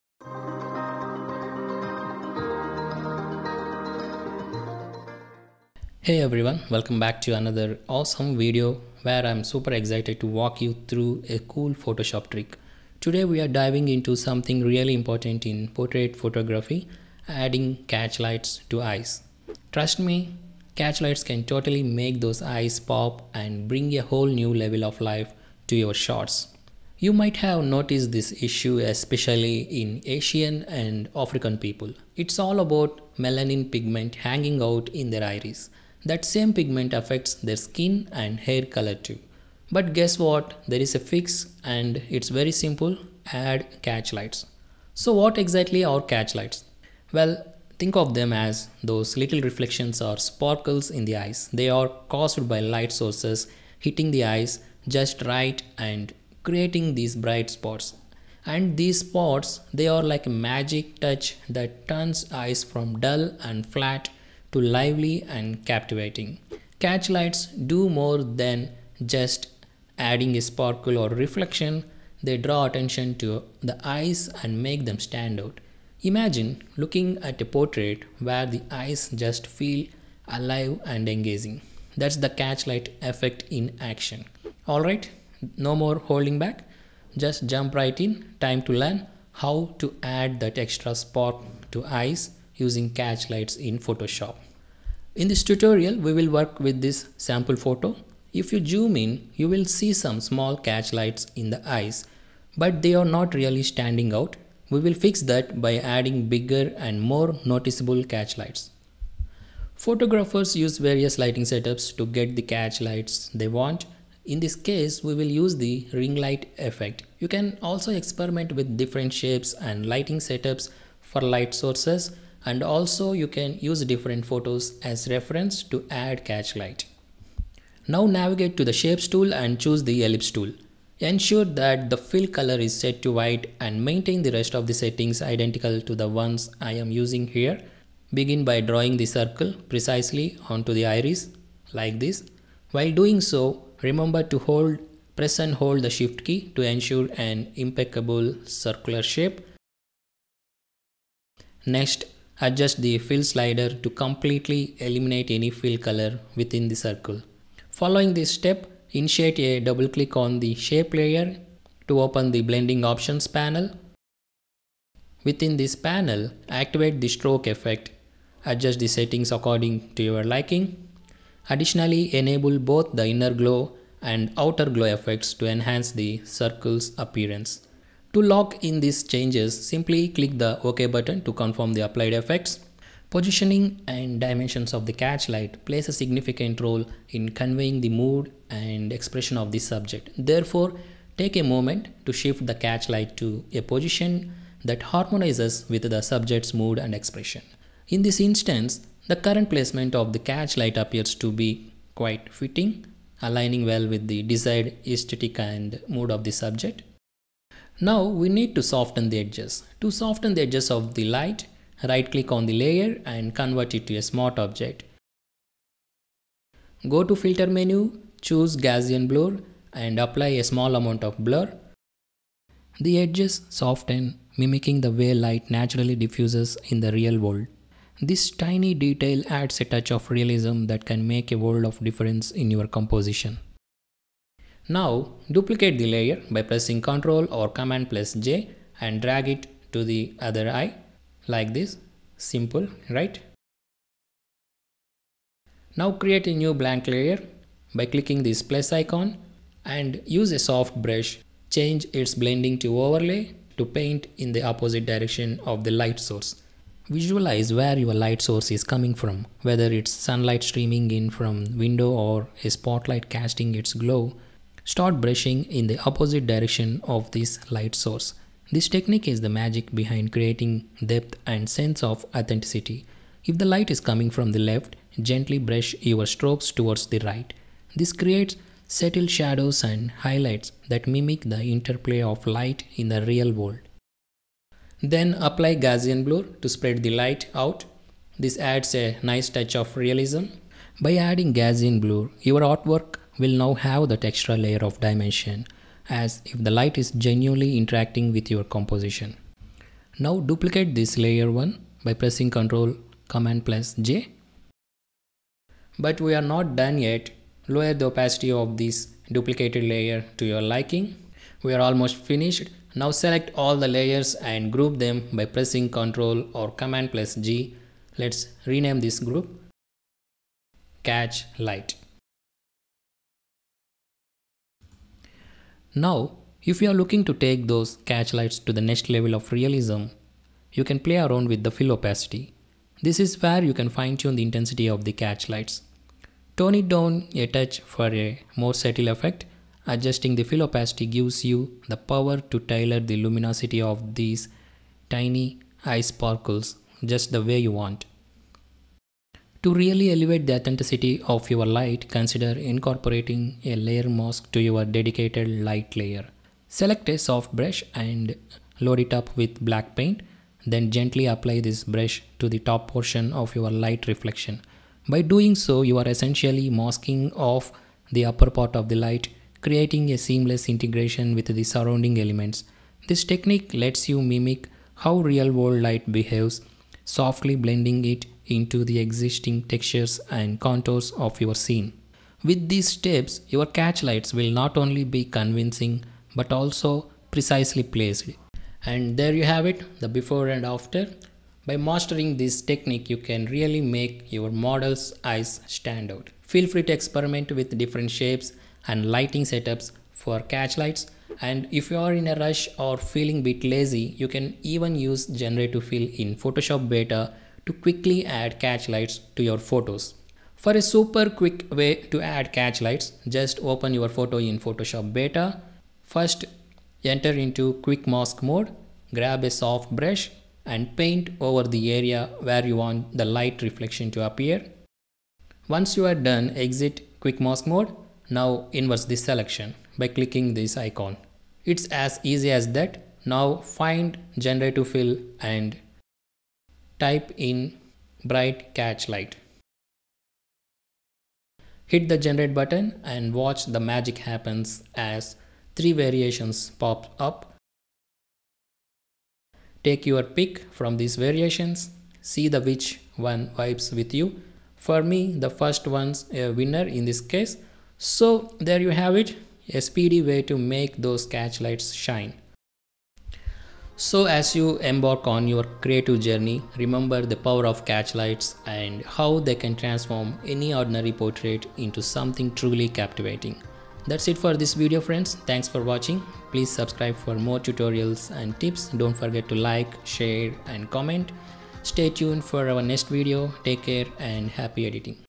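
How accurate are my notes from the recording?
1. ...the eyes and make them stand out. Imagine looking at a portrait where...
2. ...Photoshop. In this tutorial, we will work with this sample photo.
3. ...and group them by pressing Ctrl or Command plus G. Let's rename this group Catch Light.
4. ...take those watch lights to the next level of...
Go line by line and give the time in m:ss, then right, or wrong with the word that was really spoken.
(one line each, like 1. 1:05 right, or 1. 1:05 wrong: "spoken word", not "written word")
1. 1:13 right
2. 1:33 right
3. 5:14 right
4. 5:27 wrong: "catch", not "watch".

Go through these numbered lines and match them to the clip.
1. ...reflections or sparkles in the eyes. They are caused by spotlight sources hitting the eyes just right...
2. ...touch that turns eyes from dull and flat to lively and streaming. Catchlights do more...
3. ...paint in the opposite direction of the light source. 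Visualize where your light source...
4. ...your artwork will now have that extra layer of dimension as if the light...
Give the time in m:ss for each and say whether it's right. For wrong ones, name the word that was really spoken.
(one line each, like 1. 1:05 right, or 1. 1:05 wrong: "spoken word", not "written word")
1. 0:49 wrong: "light", not "spotlight"
2. 1:00 wrong: "captivating", not "streaming"
3. 4:13 right
4. 4:52 right.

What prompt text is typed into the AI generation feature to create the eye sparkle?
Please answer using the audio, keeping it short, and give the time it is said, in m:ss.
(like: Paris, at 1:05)
Bright catch light, at 7:18.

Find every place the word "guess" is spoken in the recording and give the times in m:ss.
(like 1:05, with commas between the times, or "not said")
0:39.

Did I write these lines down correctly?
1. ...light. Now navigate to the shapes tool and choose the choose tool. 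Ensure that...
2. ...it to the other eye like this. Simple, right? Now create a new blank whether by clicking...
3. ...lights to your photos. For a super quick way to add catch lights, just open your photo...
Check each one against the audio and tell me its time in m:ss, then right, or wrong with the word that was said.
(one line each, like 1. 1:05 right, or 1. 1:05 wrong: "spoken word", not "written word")
1. 2:06 wrong: "ellipse", not "choose"
2. 3:59 wrong: "layer", not "whether"
3. 6:48 right.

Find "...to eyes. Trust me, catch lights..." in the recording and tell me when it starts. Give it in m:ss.
0:18.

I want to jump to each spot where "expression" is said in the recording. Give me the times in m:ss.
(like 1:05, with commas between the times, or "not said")
3:08, 3:16.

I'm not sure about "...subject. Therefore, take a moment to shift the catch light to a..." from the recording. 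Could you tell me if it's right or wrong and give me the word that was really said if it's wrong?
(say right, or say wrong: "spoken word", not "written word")
right.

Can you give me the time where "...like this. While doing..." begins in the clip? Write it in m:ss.
2:21.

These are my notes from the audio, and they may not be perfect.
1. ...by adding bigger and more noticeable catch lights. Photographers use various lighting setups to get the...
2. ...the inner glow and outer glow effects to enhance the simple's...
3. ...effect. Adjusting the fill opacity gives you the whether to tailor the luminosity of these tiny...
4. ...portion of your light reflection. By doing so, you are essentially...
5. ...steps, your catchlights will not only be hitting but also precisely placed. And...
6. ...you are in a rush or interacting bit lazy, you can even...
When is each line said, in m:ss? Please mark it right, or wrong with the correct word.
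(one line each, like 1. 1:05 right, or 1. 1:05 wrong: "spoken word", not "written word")
1. 1:45 right
2. 2:52 wrong: "circle", not "simple"
3. 5:38 wrong: "power", not "whether"
4. 6:02 right
5. 6:22 wrong: "convincing", not "hitting"
6. 6:41 wrong: "feeling", not "interacting".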